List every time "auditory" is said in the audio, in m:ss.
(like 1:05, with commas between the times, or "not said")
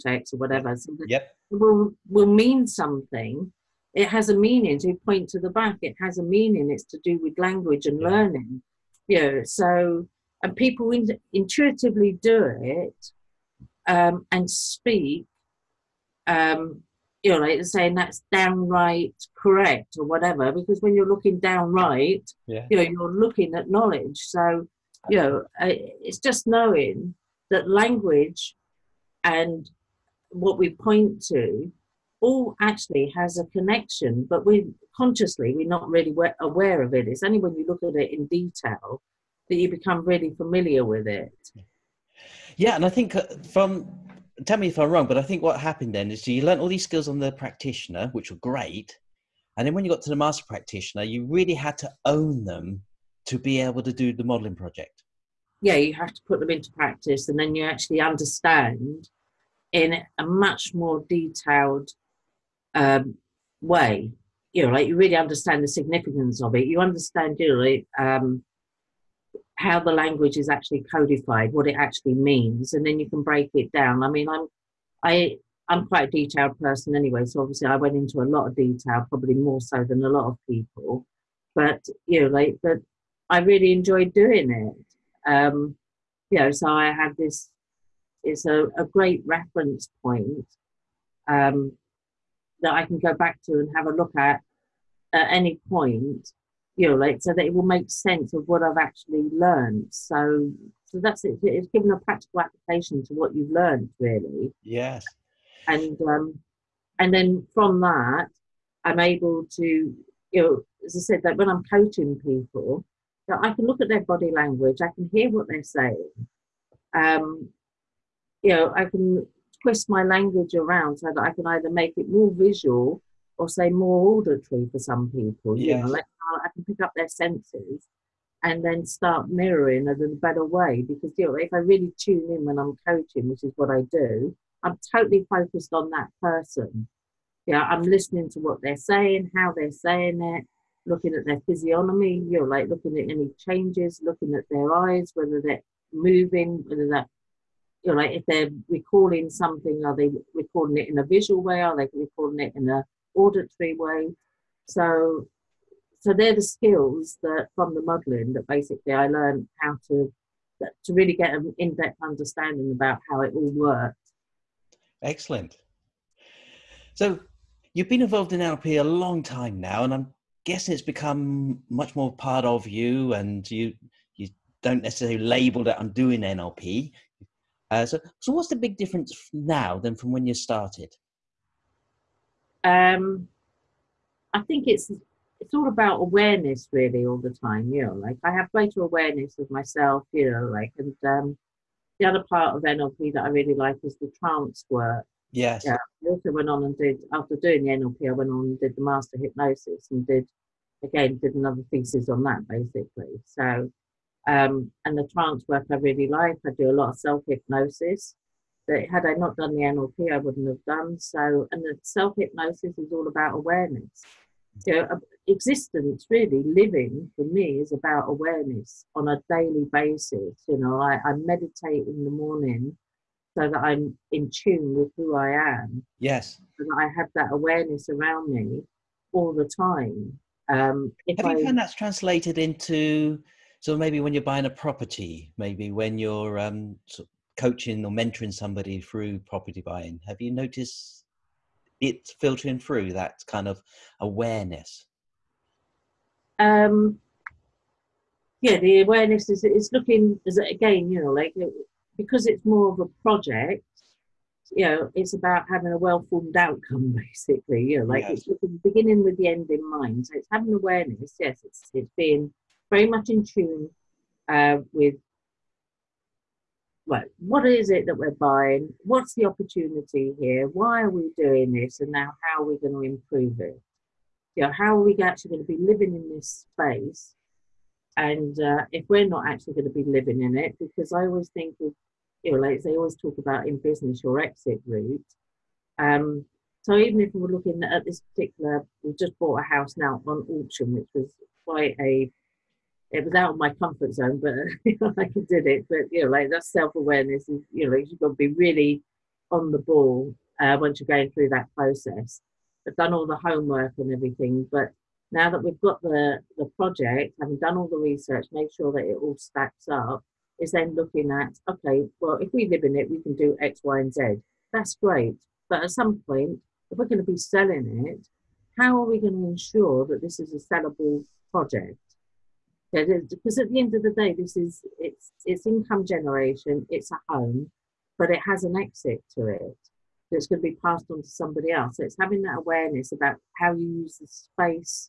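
2:04, 2:33.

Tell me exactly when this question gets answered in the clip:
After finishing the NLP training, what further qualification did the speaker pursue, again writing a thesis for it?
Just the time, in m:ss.
3:18.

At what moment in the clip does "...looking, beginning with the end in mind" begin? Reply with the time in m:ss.
4:18.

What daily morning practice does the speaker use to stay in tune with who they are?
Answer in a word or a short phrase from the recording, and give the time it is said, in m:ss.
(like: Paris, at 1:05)
meditate, at 3:41.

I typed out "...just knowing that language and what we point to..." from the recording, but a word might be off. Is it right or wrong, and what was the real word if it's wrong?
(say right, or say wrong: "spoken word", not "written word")
right.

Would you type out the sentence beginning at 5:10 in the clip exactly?
Is then looking at okay, well, if we live in it, we can do X, Y, and Z.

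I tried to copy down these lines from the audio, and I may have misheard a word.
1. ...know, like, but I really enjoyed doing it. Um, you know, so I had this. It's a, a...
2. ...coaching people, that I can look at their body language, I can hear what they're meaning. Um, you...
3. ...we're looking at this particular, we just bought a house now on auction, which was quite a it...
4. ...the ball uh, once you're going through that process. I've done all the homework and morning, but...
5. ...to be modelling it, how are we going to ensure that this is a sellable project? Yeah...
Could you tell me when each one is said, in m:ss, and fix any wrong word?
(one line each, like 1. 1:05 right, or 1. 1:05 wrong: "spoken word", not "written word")
1. 1:22 right
2. 1:51 wrong: "saying", not "meaning"
3. 4:47 right
4. 4:59 wrong: "everything", not "morning"
5. 5:17 wrong: "selling", not "modelling".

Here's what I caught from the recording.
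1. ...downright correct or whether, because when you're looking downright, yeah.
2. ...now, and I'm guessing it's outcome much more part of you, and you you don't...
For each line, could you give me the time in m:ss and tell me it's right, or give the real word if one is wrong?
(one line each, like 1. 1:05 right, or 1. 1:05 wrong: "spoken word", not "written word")
1. 0:18 wrong: "whatever", not "whether"
2. 2:49 wrong: "become", not "outcome".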